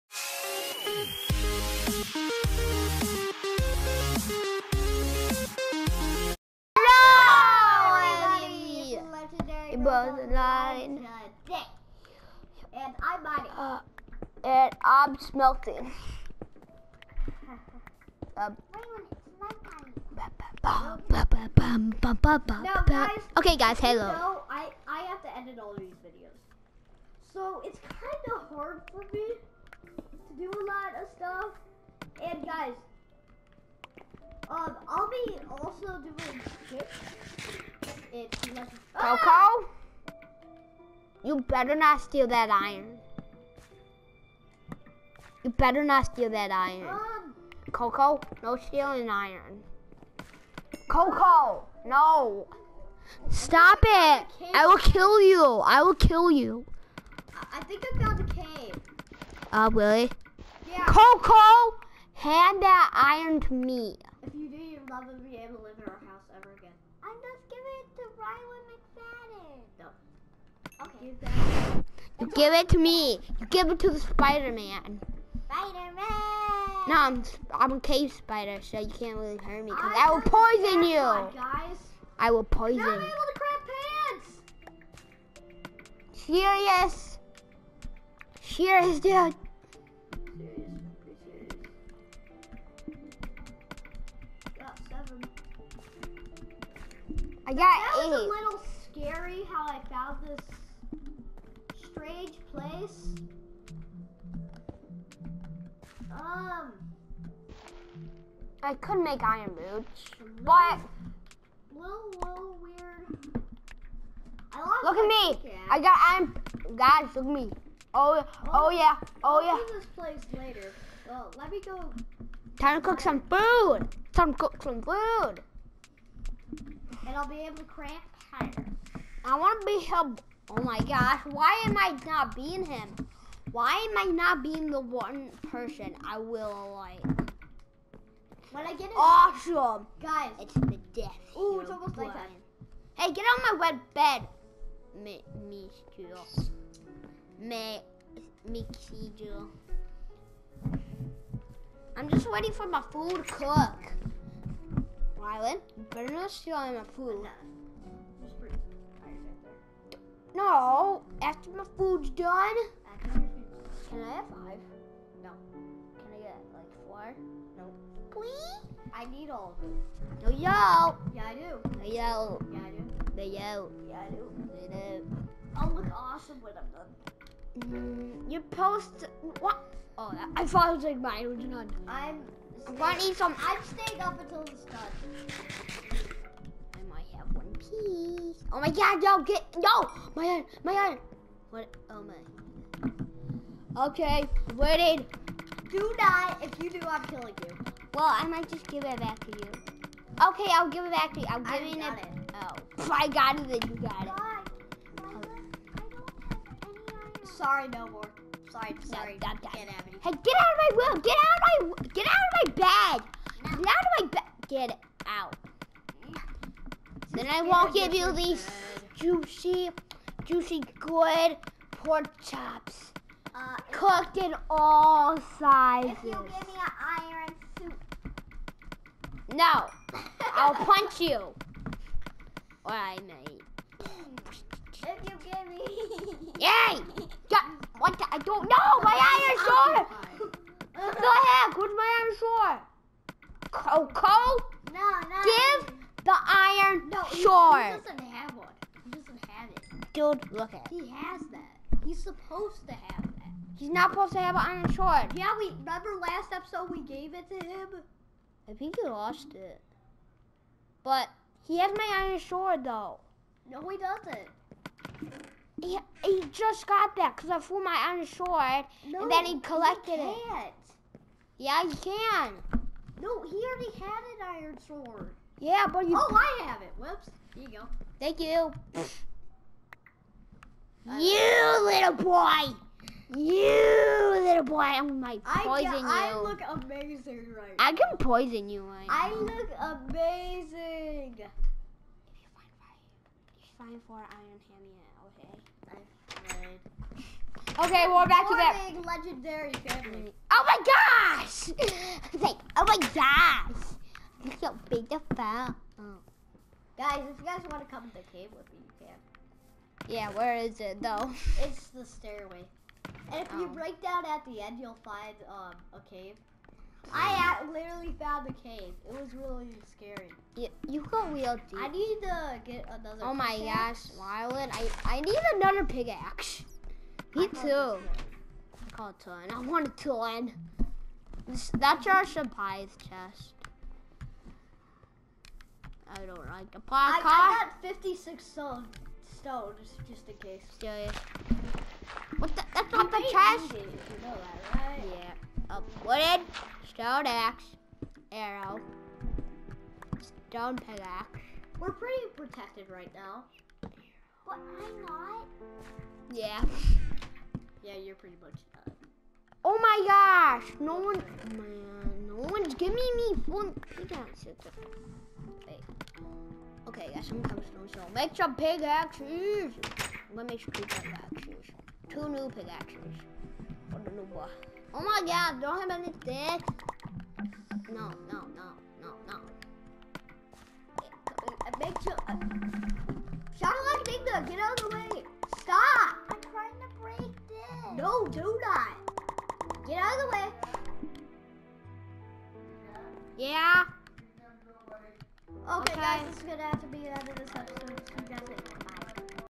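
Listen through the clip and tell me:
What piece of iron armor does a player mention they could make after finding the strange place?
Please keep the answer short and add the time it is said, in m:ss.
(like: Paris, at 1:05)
Iron boots, at 1:49.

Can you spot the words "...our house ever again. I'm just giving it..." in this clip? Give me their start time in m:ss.
1:05.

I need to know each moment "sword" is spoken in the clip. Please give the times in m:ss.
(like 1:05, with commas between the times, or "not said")
4:14, 4:22, 4:28, 4:34.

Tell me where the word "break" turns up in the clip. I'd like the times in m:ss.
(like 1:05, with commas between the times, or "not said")
5:13, 6:26.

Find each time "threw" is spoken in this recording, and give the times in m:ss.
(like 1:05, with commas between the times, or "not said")
4:27.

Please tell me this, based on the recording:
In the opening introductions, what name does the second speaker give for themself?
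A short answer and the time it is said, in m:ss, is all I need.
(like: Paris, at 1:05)
Bonnie, at 0:13.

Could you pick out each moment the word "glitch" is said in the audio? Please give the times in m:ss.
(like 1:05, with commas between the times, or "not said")
not said.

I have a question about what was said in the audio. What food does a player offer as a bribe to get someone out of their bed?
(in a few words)
Pork chops.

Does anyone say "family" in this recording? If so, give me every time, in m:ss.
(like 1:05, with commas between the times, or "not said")
4:59.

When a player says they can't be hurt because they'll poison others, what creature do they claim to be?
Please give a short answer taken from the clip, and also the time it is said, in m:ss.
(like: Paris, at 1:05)
A cave spider, at 1:17.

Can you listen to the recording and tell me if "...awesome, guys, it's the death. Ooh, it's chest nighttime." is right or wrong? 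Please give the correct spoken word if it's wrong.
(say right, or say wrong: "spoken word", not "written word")
wrong: "almost", not "chest".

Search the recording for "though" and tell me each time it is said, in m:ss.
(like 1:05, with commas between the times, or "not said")
4:22, 5:10.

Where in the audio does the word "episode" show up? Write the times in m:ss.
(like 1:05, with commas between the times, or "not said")
4:16, 6:37.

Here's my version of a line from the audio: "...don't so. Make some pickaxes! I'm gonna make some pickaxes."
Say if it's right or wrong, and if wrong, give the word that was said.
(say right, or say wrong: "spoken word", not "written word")
right.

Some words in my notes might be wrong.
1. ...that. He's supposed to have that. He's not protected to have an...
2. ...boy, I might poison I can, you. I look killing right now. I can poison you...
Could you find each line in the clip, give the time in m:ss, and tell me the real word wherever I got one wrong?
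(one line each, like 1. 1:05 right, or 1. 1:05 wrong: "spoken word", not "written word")
1. 4:11 wrong: "supposed", not "protected"
2. 4:44 wrong: "amazing", not "killing".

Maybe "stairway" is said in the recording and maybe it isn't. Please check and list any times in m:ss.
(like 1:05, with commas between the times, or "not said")
5:11.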